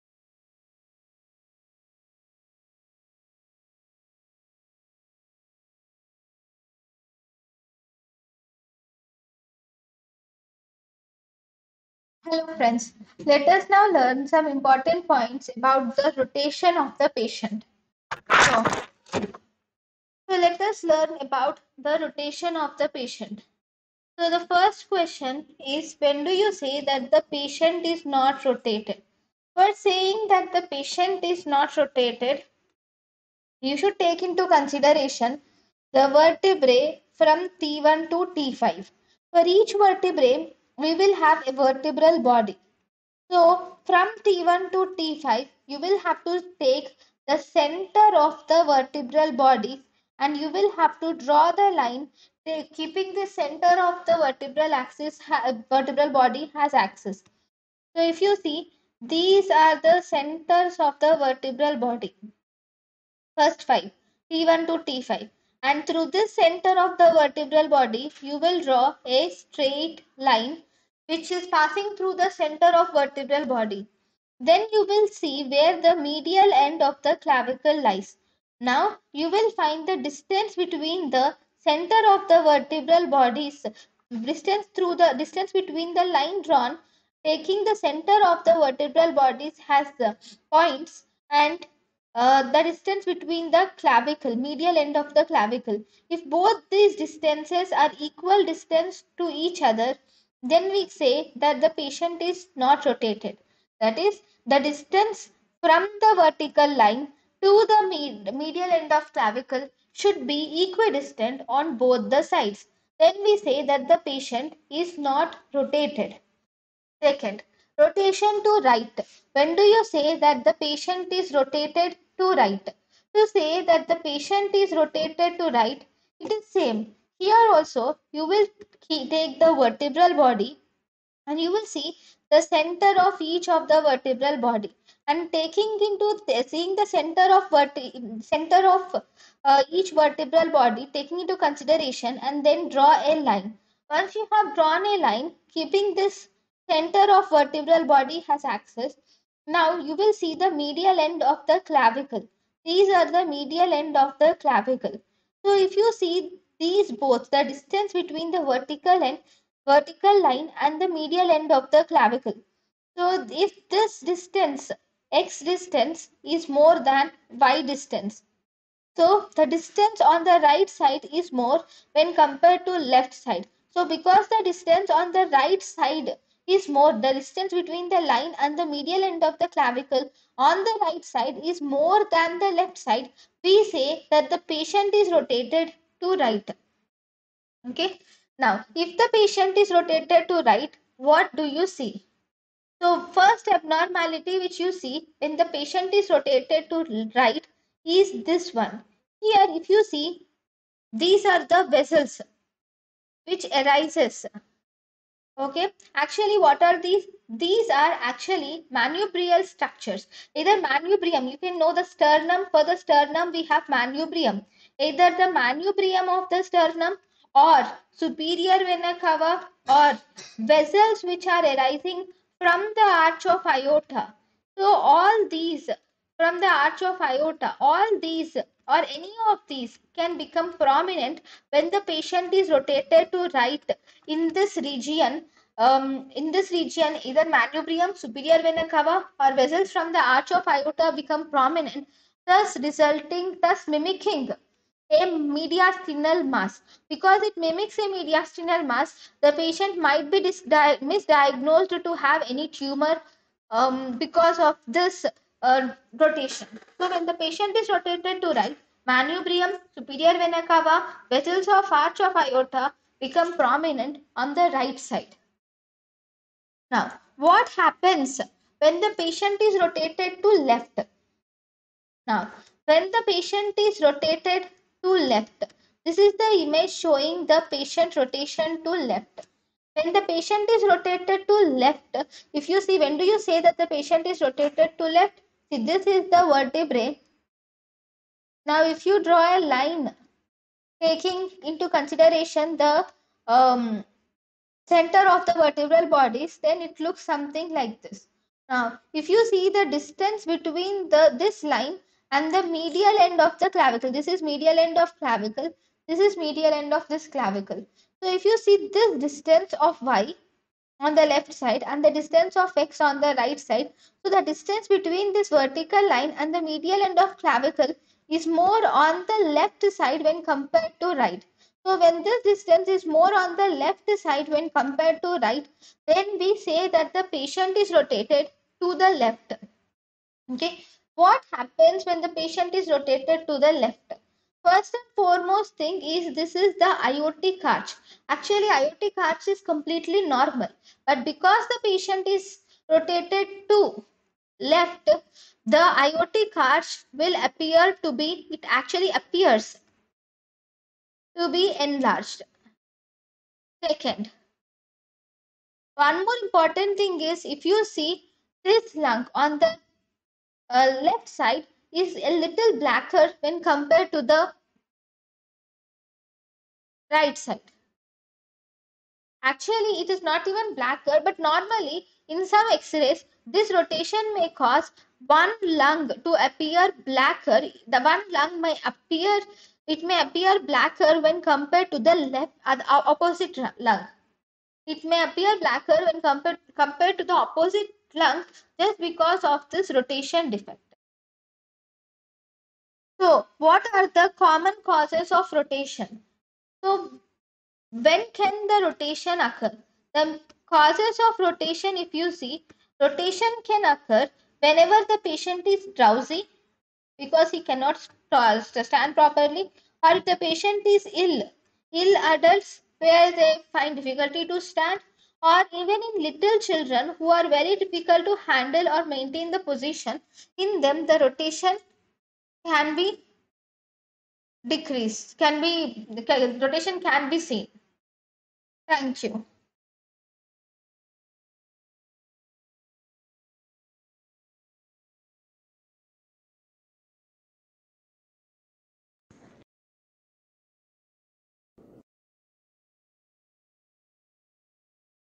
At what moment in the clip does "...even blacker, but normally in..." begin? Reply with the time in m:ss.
6:10.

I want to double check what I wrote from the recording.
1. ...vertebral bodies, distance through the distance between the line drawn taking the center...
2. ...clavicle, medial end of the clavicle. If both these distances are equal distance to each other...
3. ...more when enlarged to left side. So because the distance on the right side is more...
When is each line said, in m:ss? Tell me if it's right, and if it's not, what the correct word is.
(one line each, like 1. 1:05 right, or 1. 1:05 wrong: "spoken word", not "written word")
1. 1:22 right
2. 1:33 right
3. 2:51 wrong: "compared", not "enlarged".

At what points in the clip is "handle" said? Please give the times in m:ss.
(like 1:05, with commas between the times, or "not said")
6:58.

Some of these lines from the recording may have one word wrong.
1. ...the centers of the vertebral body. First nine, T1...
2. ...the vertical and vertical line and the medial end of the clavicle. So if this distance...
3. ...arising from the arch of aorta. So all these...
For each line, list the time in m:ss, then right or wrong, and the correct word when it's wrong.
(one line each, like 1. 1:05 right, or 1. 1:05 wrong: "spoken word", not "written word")
1. 0:59 wrong: "five", not "nine"
2. 2:38 right
3. 3:41 right.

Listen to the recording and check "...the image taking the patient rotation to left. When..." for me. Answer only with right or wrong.
wrong.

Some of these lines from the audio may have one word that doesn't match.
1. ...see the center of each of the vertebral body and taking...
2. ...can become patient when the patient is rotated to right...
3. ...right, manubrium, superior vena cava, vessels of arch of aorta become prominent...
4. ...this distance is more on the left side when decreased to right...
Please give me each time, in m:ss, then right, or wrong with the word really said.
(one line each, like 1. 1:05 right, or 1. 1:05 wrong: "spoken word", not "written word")
1. 2:11 right
2. 3:49 wrong: "prominent", not "patient"
3. 4:18 right
4. 5:22 wrong: "compared", not "decreased".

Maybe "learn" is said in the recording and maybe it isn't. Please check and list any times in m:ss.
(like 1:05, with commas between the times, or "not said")
0:13, 0:20.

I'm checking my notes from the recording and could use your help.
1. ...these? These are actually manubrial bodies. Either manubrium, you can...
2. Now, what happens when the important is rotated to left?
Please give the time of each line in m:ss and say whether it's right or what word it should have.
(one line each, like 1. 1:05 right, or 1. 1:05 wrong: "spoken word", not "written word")
1. 3:26 wrong: "structures", not "bodies"
2. 4:26 wrong: "patient", not "important".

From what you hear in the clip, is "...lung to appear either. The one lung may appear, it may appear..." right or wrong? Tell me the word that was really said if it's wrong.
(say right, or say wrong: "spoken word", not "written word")
wrong: "blacker", not "either".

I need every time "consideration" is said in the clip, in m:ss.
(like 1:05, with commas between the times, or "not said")
0:34, 2:21, 4:51.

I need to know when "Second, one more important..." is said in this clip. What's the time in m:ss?
5:53.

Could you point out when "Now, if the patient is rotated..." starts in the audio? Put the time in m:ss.
3:08.